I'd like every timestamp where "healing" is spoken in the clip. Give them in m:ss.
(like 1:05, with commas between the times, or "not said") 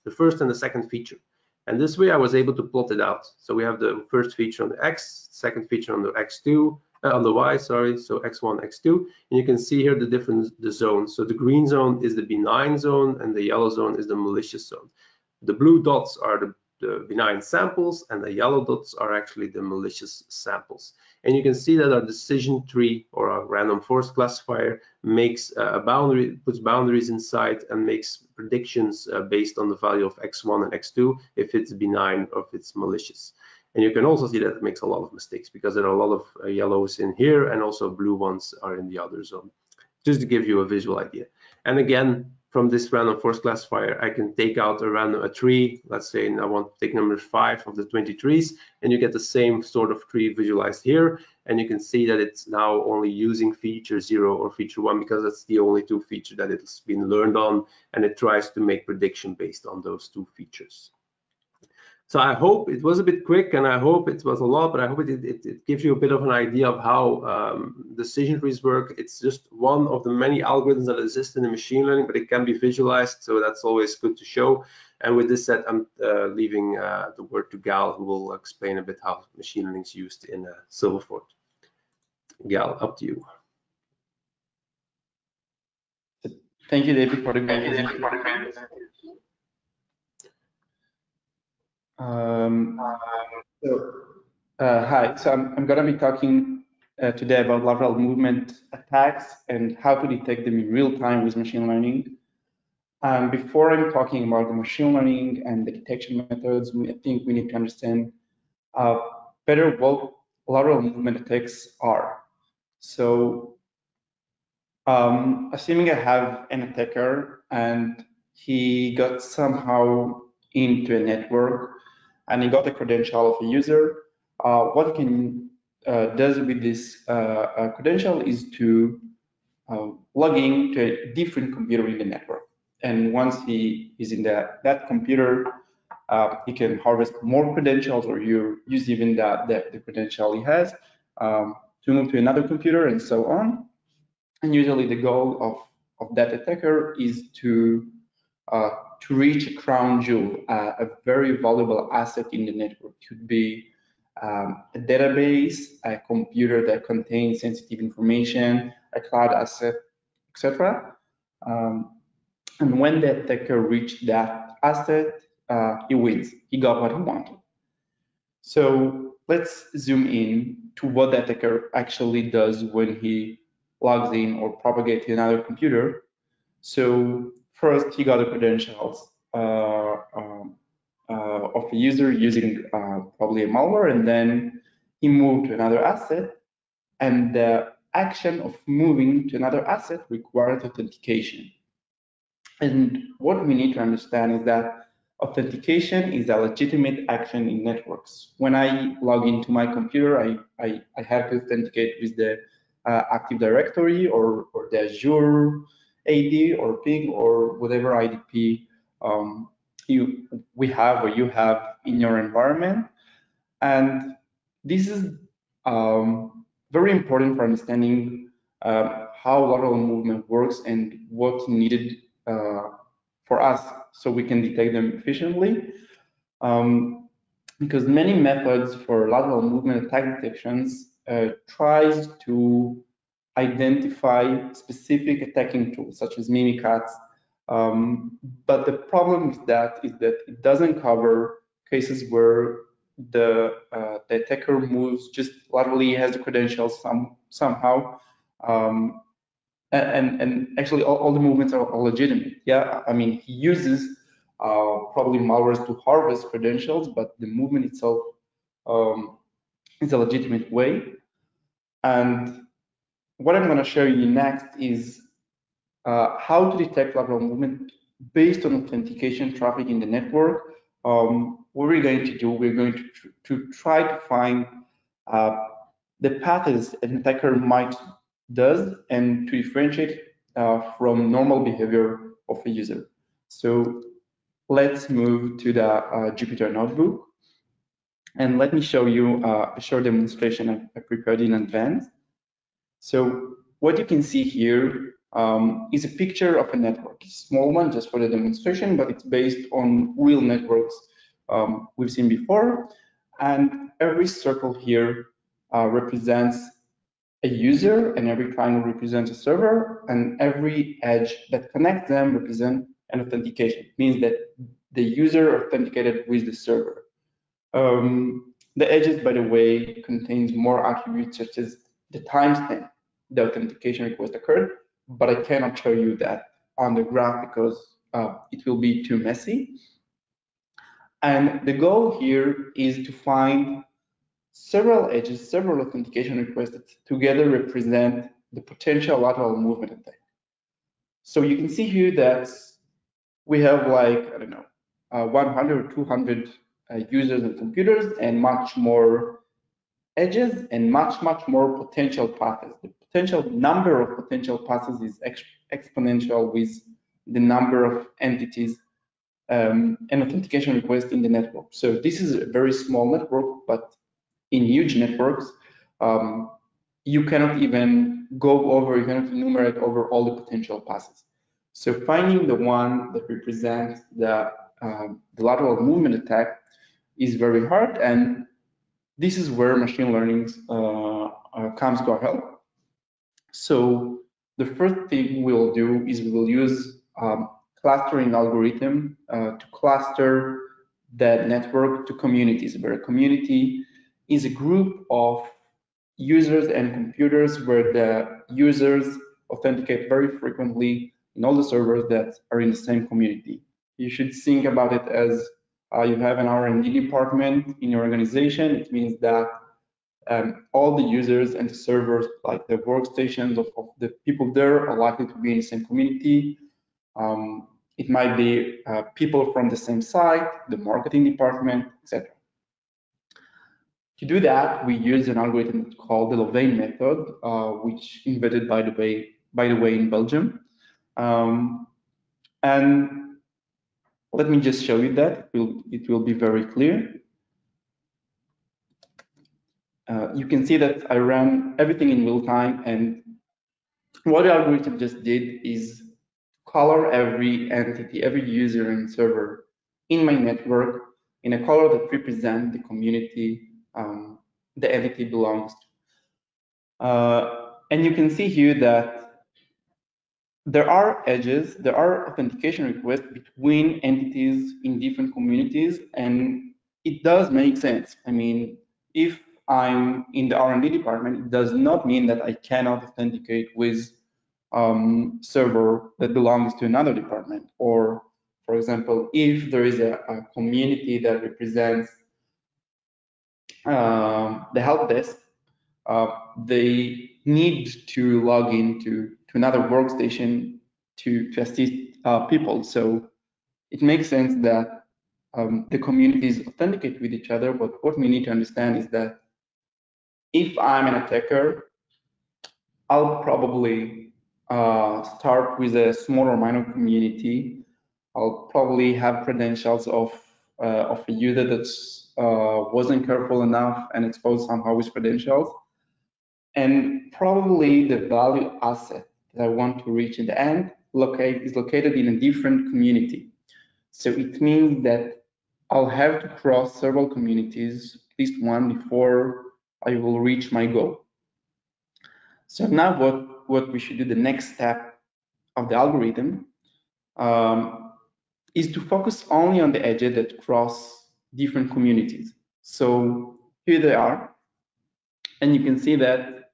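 not said.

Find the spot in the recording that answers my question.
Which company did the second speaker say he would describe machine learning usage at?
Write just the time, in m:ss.
1:20.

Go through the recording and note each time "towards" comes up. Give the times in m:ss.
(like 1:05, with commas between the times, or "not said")
not said.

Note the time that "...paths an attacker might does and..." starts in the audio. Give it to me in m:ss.
4:36.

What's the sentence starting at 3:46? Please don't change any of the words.
Um, because many methods for lateral movement attack detections uh, tries to identify specific attacking tools such as Mimikatz.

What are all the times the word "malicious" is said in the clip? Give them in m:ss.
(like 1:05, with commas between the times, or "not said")
0:14, 0:19, 0:32.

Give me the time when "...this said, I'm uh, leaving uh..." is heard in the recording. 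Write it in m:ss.
1:15.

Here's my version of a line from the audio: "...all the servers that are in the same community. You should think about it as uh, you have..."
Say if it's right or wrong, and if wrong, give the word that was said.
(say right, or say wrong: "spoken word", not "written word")
right.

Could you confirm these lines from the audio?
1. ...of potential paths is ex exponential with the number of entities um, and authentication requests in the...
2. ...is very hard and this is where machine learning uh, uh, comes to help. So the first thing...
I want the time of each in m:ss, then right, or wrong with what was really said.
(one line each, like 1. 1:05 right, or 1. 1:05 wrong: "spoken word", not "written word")
1. 5:53 right
2. 6:16 right.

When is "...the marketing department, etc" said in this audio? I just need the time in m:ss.
7:00.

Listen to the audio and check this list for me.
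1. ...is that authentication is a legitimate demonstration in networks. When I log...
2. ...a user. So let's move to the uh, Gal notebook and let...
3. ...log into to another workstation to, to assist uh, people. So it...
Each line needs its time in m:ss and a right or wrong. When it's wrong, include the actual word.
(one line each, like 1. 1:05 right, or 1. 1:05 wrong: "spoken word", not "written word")
1. 3:14 wrong: "action", not "demonstration"
2. 4:42 wrong: "Jupyter", not "Gal"
3. 8:08 right.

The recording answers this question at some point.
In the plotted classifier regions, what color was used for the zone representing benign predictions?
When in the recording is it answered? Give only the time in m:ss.
0:11.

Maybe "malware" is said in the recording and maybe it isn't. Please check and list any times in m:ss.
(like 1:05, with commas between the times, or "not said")
3:03, 4:15.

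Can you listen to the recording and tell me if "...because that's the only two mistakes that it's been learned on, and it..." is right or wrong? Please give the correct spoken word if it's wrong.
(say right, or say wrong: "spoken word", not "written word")
wrong: "features", not "mistakes".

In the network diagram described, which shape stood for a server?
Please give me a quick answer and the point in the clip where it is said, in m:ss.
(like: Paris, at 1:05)
Triangle, at 5:08.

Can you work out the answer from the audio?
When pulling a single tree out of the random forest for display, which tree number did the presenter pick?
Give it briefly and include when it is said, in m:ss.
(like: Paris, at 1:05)
5, at 0:46.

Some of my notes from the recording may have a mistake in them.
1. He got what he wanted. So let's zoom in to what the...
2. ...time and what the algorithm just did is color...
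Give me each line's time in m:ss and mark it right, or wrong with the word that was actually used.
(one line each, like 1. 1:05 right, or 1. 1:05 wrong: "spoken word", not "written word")
1. 2:46 right
2. 7:22 right.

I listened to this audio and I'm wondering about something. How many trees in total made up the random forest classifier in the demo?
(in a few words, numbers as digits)
20.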